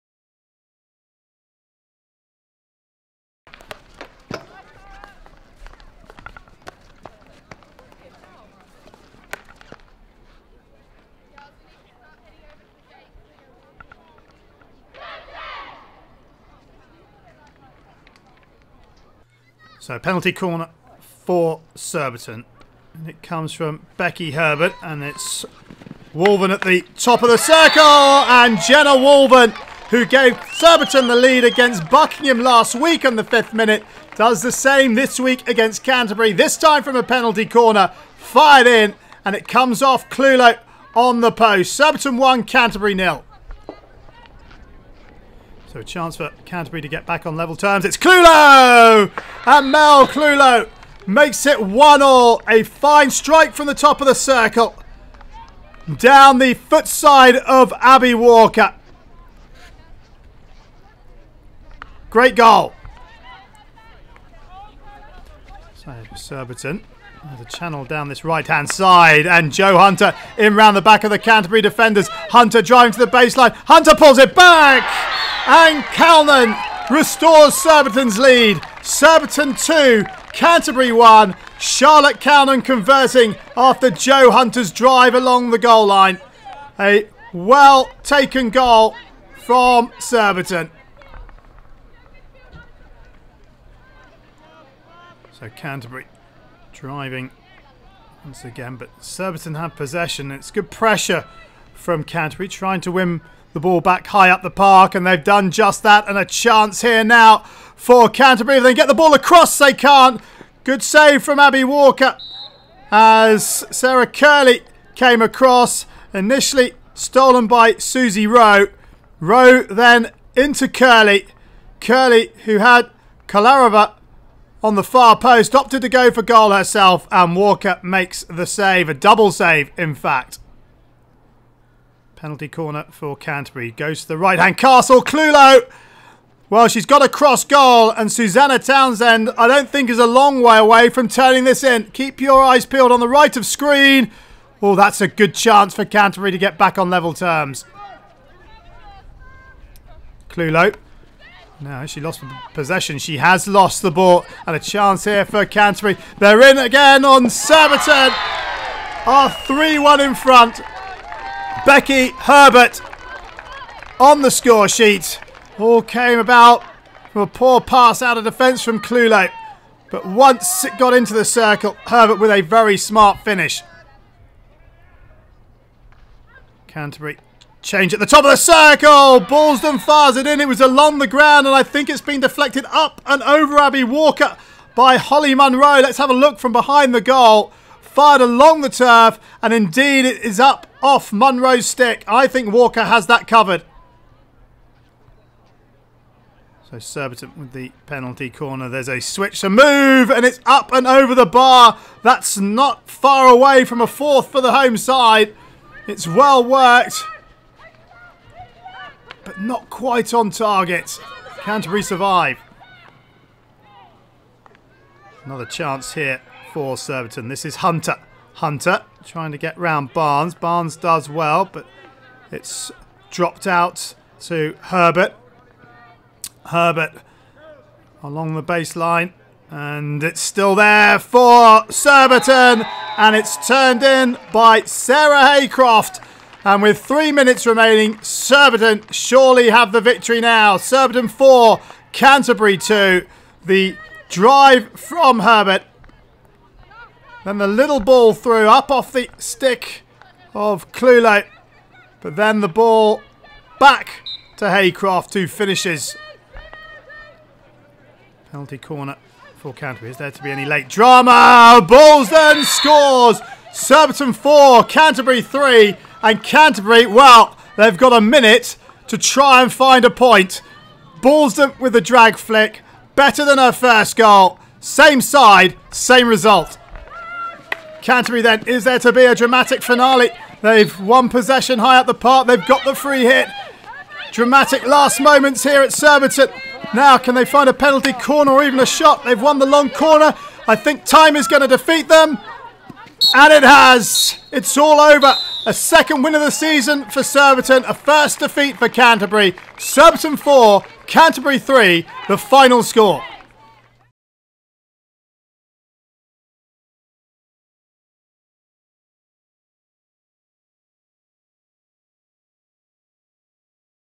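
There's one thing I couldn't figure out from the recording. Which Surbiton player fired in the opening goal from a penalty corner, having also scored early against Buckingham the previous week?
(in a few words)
Jenna Woolven.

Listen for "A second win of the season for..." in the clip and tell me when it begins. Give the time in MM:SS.
04:55.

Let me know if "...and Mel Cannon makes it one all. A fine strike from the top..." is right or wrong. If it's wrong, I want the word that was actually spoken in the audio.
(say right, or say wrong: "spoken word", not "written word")
wrong: "Clewlow", not "Cannon".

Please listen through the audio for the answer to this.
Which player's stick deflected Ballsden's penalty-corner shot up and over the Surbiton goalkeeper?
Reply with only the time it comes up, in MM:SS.
03:04.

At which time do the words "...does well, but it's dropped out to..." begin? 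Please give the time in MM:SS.
03:40.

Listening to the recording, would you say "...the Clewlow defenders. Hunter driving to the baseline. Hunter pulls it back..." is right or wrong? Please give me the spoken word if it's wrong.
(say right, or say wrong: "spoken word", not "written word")
wrong: "Canterbury", not "Clewlow".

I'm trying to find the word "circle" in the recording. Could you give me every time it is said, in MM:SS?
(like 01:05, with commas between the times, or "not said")
00:27, 00:54, 02:51, 02:58.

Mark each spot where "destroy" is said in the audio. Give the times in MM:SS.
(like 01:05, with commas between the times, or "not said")
not said.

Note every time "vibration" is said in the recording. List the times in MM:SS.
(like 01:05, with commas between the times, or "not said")
not said.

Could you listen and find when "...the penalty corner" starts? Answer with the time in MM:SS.
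03:17.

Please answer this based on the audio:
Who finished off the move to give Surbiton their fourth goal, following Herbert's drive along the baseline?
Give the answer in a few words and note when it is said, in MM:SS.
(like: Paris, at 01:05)
Sarah Haycroft, at 03:54.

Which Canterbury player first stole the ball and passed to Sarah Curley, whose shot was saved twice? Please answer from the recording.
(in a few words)
Susie Rowe.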